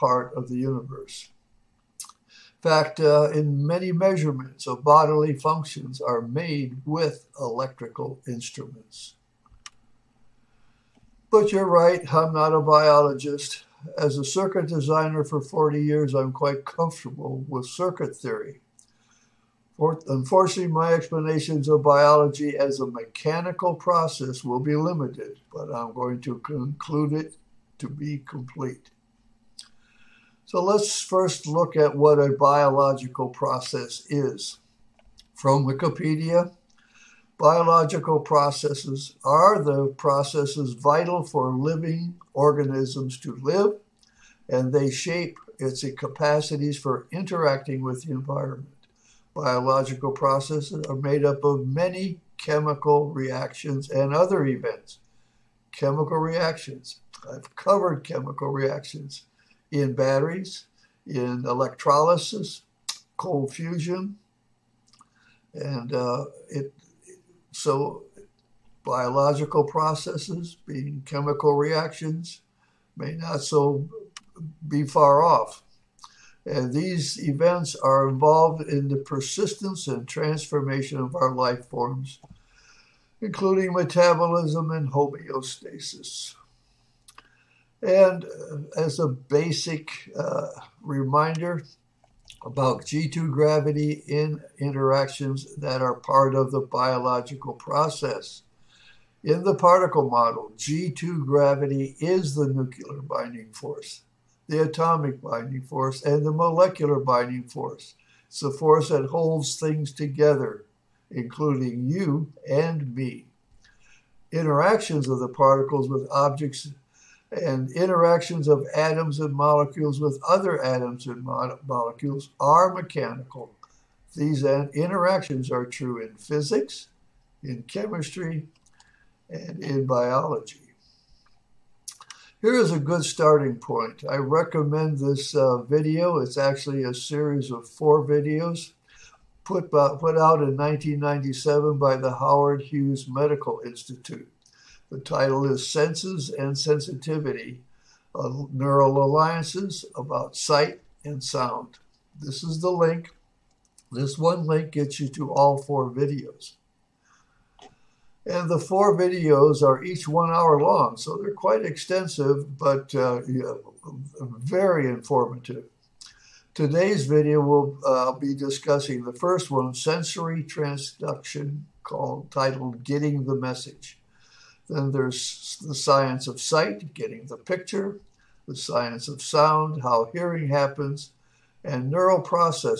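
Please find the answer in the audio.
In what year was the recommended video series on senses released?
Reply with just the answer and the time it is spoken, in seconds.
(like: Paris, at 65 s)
1997, at 140 s.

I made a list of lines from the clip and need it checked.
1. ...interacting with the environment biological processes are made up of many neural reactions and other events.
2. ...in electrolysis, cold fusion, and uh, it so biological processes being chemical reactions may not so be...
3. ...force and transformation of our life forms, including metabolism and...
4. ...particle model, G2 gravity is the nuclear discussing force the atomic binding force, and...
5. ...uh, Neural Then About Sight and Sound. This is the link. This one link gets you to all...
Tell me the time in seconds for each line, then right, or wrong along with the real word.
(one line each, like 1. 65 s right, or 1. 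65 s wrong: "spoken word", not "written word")
1. 47 s wrong: "chemical", not "neural"
2. 61 s right
3. 78 s wrong: "persistence", not "force"
4. 99 s wrong: "binding", not "discussing"
5. 148 s wrong: "Alliances", not "Then".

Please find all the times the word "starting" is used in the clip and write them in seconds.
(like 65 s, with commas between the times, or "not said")
133 s.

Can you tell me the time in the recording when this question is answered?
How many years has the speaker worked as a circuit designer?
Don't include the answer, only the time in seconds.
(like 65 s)
15 s.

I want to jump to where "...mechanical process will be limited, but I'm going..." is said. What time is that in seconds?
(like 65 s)
22 s.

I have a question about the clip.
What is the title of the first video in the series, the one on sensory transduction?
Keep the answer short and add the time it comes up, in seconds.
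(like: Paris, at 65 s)
Getting the Message, at 172 s.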